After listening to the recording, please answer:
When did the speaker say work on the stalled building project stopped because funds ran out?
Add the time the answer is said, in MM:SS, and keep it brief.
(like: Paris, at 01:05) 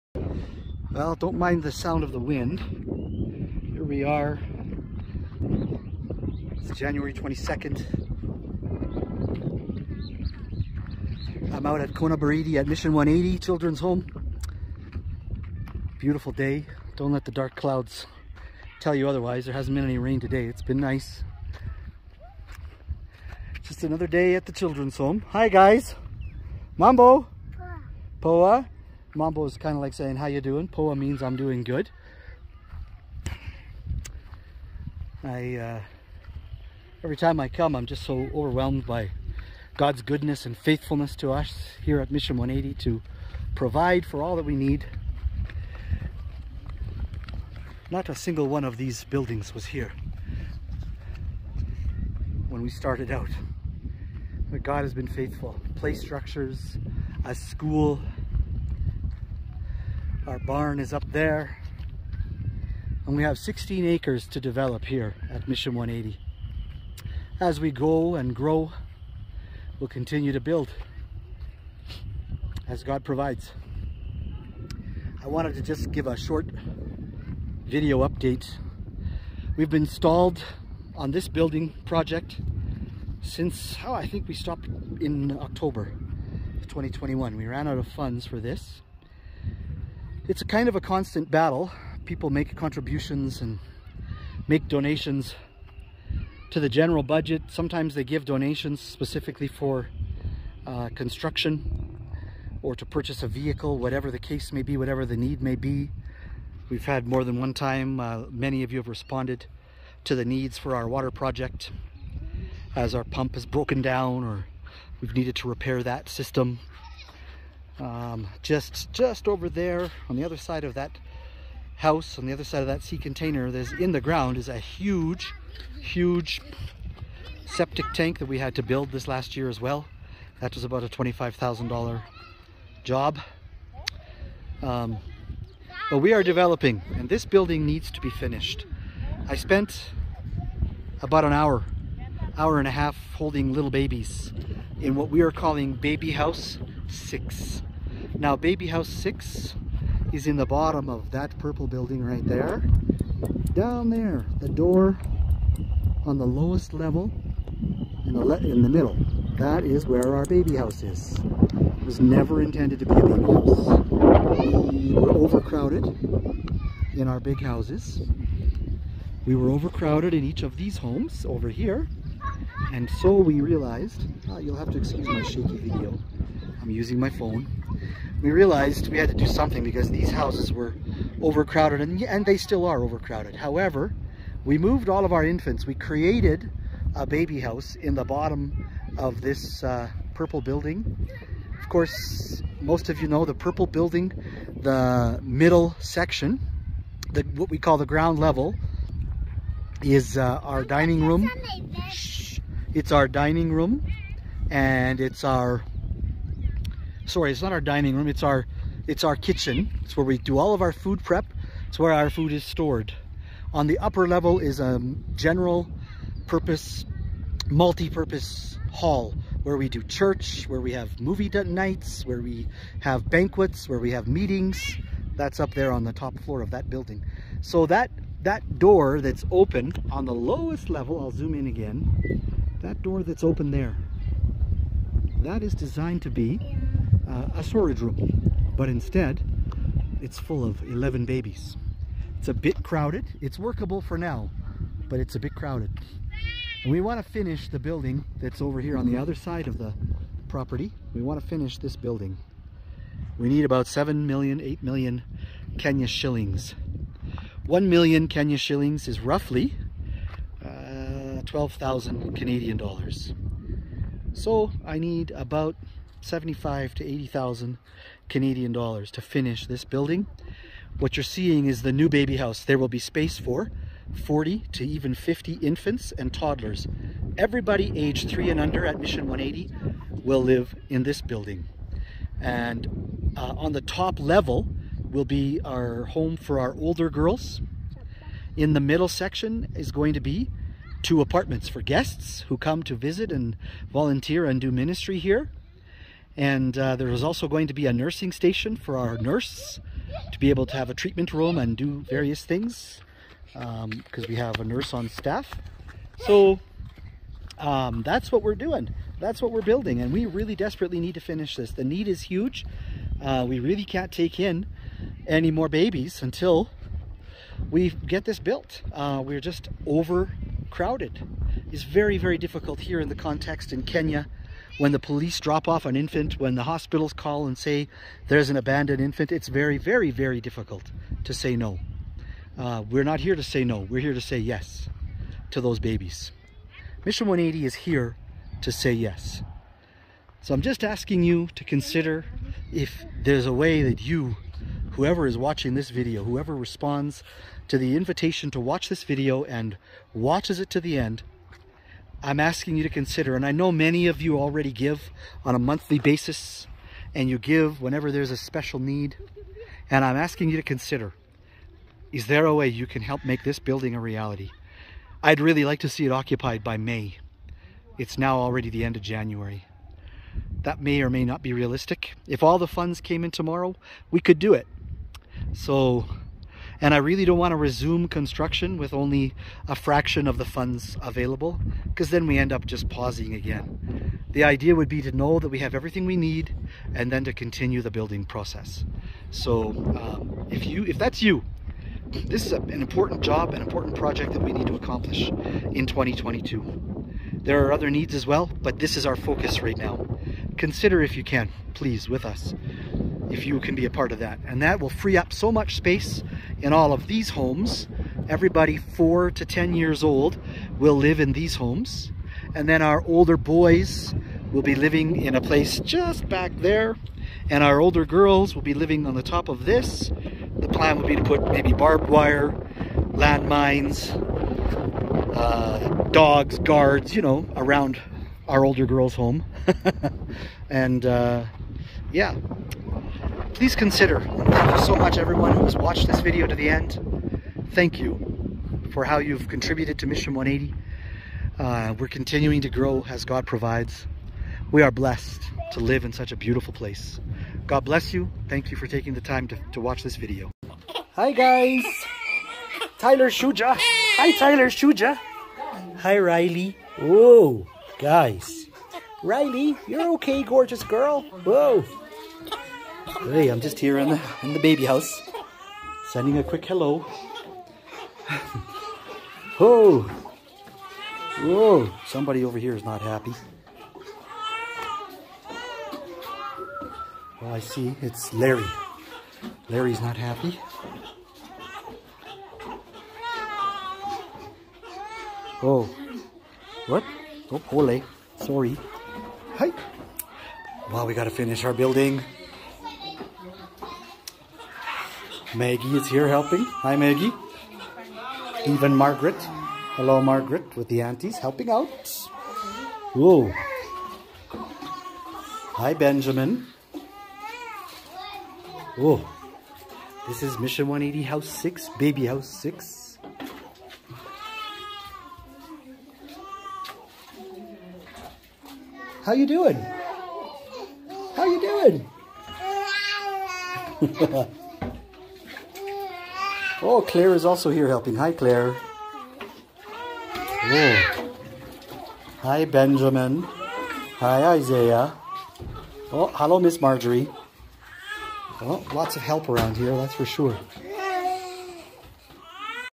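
October 2021, at 01:25.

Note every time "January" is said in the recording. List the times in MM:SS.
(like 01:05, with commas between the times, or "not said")
00:06, 06:08.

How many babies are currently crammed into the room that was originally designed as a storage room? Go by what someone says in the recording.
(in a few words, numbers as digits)
11.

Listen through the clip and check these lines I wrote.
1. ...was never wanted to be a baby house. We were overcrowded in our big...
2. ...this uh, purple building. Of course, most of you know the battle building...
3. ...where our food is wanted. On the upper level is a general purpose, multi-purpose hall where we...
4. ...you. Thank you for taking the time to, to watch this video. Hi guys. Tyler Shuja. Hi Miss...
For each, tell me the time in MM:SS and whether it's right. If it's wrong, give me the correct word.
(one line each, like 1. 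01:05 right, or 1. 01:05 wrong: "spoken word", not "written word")
1. 02:41 wrong: "intended", not "wanted"
2. 03:09 wrong: "purple", not "battle"
3. 03:31 wrong: "stored", not "wanted"
4. 07:27 wrong: "Tyler", not "Miss".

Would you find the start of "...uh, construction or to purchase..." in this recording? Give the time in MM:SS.
01:40.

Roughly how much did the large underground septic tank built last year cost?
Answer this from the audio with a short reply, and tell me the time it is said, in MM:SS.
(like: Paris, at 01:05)
$25,000, at 02:10.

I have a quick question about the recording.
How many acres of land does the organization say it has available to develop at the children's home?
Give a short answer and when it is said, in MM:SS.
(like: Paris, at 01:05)
16, at 01:03.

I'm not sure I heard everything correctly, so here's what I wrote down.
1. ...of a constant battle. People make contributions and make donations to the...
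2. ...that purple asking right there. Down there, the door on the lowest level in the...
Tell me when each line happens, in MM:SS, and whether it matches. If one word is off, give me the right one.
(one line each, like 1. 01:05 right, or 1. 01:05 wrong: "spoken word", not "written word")
1. 01:30 right
2. 02:31 wrong: "building", not "asking".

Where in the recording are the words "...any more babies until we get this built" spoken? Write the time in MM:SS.
05:15.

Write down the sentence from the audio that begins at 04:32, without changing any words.
There will be space for 40 to even 50 infants and toddlers.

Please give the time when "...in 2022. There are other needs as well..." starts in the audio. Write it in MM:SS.
06:35.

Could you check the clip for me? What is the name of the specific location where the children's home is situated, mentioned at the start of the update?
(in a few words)
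Kona Baridi.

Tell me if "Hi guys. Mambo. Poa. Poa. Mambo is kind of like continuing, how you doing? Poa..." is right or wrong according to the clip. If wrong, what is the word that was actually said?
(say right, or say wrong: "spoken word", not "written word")
wrong: "saying", not "continuing".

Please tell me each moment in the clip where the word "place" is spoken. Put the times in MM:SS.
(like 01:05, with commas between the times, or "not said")
06:55, 07:26.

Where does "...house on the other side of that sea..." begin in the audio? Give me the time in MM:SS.
02:01.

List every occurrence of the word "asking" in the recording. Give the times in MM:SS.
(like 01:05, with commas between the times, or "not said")
05:40, 05:52, 05:59.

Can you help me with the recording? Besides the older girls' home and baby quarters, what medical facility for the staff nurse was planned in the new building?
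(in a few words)
nursing station.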